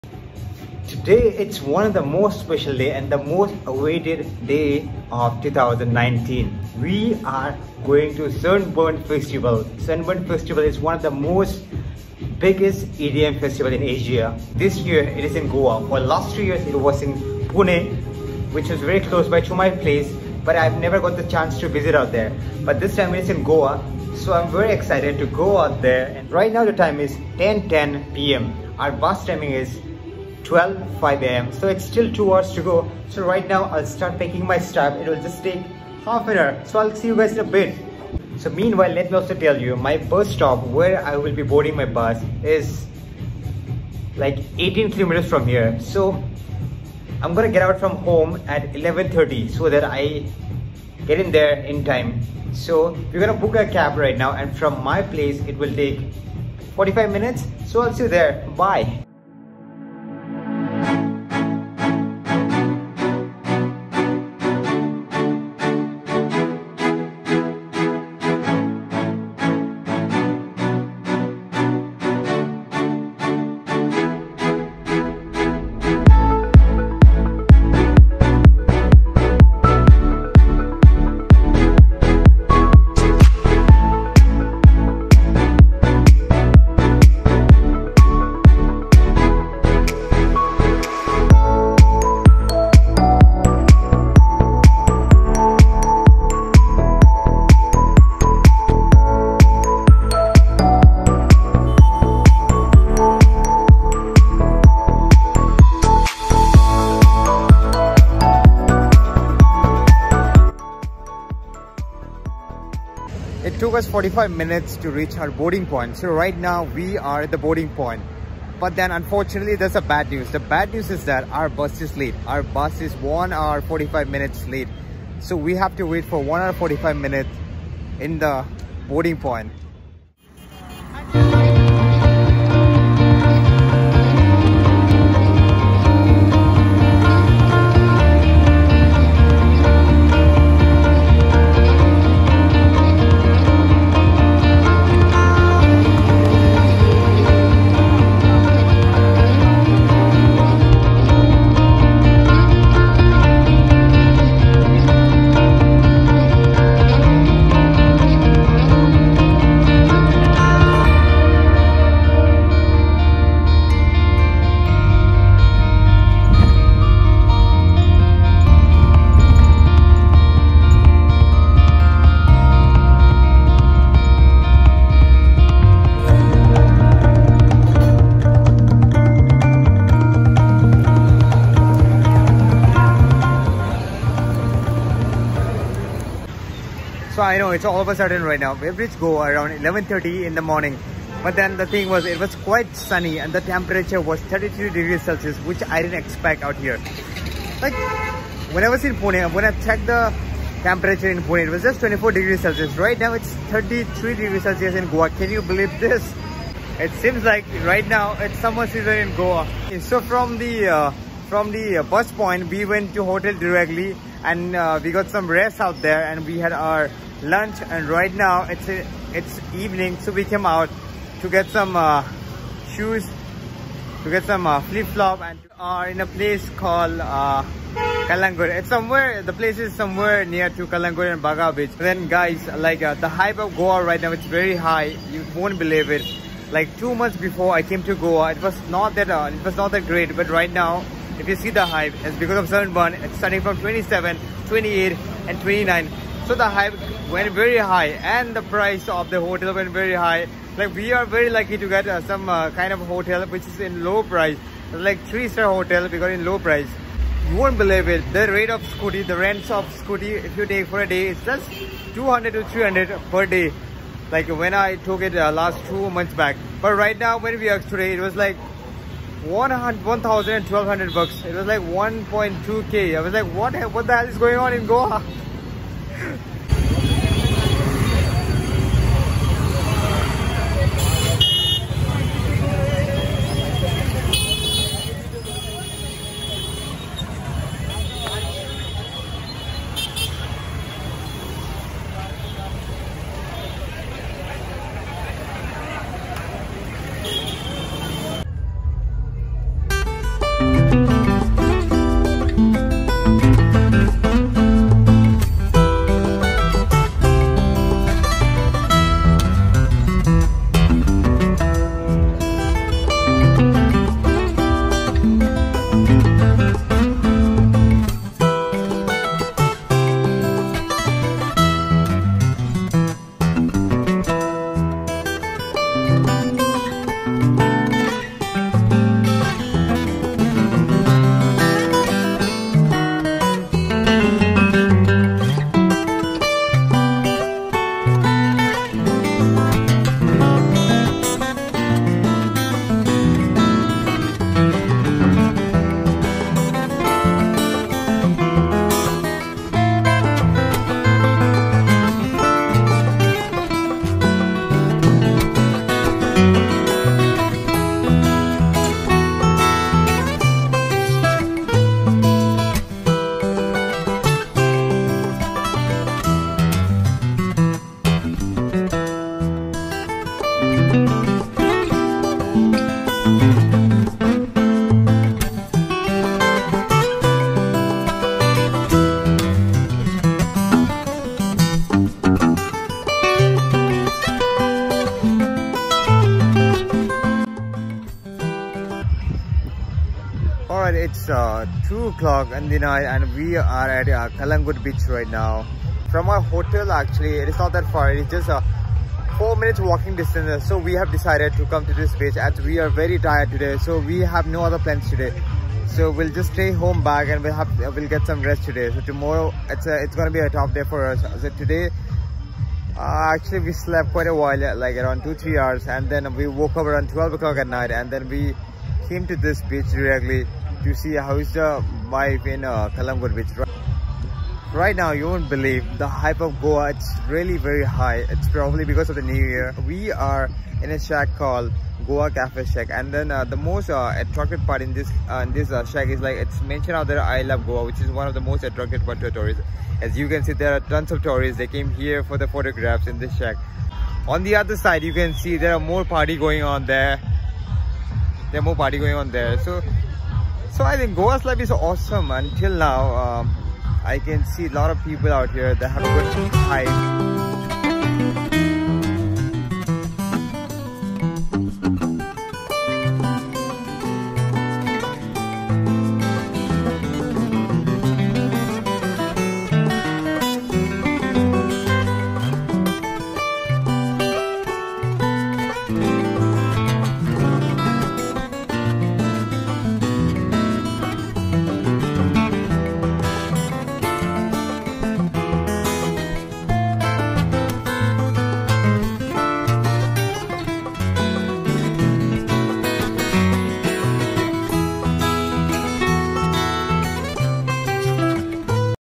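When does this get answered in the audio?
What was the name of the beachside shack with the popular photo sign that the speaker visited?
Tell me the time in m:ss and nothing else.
7:11.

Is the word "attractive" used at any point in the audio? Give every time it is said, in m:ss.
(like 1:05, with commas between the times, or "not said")
7:13, 7:18.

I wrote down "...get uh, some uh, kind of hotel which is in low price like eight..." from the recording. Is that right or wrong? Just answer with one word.
wrong.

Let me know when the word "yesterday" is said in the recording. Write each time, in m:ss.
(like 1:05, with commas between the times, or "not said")
not said.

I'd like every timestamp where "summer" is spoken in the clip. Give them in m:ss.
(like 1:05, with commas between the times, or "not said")
3:28.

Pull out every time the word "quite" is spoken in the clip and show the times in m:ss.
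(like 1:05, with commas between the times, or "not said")
3:12, 6:53.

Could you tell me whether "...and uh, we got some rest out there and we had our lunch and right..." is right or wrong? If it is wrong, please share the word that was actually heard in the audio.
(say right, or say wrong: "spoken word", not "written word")
right.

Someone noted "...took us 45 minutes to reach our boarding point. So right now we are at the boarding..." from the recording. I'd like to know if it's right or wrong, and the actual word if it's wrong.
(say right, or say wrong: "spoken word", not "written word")
right.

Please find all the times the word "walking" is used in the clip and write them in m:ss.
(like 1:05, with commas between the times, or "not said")
6:39.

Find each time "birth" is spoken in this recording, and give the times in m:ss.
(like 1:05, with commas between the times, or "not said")
not said.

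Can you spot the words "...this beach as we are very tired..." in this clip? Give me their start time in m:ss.
6:41.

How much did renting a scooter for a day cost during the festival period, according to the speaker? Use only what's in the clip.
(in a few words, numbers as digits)
1,200 rupees.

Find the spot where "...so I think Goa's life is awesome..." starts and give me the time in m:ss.
7:30.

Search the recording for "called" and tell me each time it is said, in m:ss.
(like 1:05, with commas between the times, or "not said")
3:46, 7:11.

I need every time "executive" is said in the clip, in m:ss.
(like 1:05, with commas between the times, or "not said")
not said.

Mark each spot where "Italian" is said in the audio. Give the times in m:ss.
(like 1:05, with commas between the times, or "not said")
not said.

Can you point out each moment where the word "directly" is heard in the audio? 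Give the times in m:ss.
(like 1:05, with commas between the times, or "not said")
3:33, 6:59.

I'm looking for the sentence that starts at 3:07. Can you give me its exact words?
I know it's all of a sudden right now.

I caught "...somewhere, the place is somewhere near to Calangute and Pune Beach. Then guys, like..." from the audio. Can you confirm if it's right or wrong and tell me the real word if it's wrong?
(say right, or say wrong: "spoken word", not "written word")
wrong: "Baga", not "Pune".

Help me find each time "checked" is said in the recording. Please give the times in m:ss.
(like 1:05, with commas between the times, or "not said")
3:19.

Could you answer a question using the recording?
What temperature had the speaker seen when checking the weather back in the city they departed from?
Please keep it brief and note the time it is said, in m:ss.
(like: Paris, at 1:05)
24 degrees Celsius, at 3:21.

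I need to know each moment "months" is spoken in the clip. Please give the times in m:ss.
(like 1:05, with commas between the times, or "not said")
3:56, 4:25.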